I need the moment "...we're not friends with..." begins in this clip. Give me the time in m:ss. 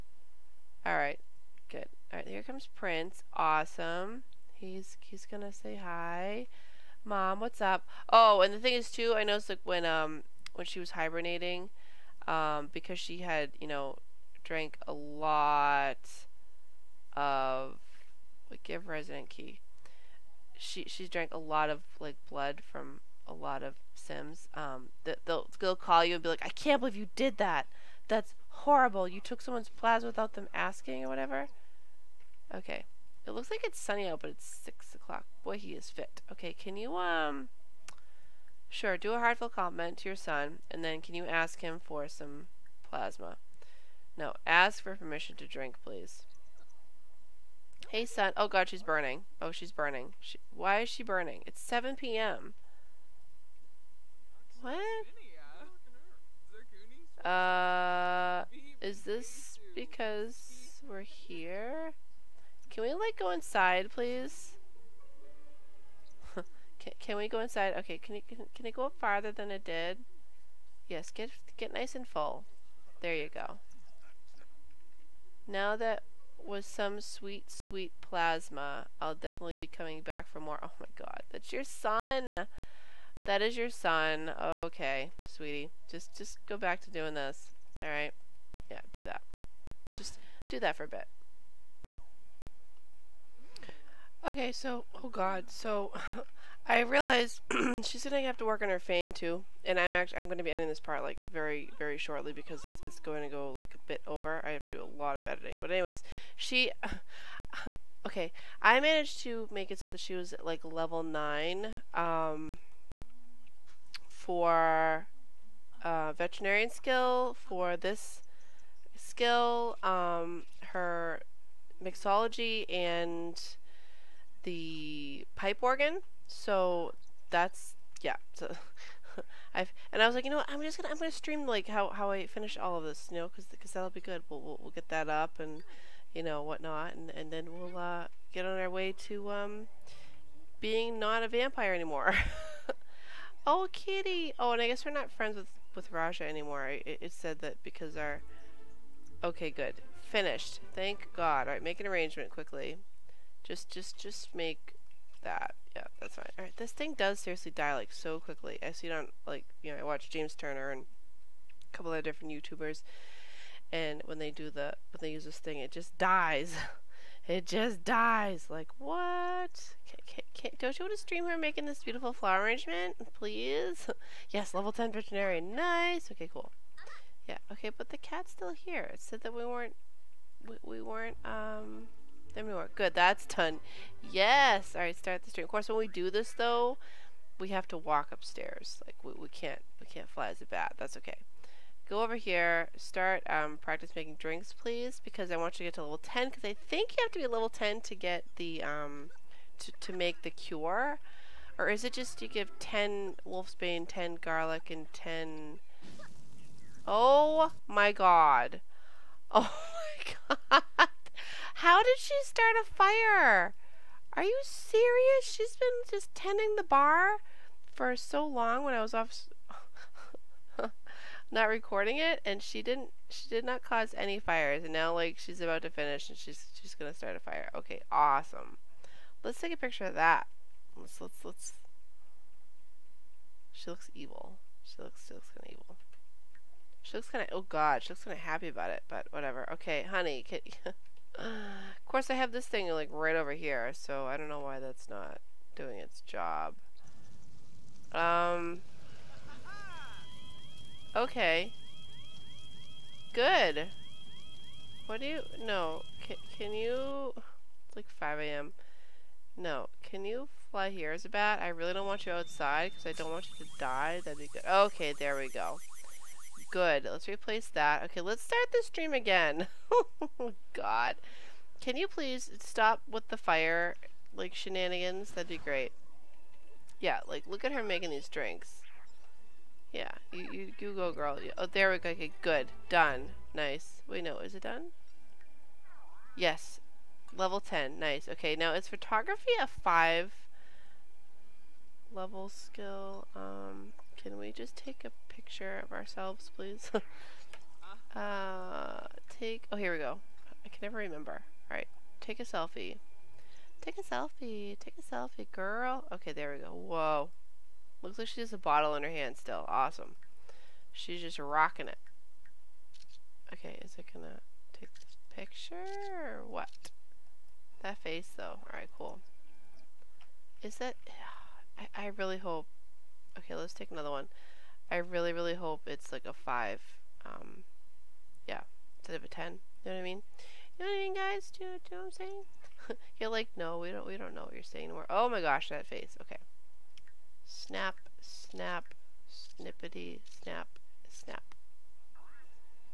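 2:24.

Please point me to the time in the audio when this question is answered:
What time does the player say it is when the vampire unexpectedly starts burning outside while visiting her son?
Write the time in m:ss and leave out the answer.
0:51.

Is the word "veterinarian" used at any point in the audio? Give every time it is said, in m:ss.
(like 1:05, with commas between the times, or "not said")
1:56, 2:54.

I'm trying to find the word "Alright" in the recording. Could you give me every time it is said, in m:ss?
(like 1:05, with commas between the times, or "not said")
1:27, 2:36, 3:04, 5:01, 5:18.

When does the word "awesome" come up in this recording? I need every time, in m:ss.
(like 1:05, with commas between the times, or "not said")
0:03, 3:47, 5:09.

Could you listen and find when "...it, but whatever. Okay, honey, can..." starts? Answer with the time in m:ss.
3:58.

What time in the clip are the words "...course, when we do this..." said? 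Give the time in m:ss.
3:05.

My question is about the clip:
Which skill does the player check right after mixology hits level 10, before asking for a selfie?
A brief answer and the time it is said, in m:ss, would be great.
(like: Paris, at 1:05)
photography, at 4:48.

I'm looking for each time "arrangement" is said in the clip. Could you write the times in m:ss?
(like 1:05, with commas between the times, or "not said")
2:31, 2:52.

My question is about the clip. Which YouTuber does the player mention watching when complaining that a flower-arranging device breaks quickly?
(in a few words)
James Turner.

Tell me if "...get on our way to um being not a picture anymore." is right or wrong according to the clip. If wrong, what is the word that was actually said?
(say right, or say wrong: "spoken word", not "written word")
wrong: "vampire", not "picture".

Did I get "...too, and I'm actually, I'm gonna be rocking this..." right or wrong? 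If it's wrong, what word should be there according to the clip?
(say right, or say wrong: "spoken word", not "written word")
wrong: "ending", not "rocking".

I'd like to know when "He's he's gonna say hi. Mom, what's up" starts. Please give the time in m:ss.
0:04.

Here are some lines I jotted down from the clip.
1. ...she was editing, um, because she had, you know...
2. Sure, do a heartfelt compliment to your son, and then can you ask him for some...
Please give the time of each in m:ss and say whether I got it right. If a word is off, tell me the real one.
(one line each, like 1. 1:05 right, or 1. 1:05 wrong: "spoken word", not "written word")
1. 0:10 wrong: "hibernating", not "editing"
2. 0:38 right.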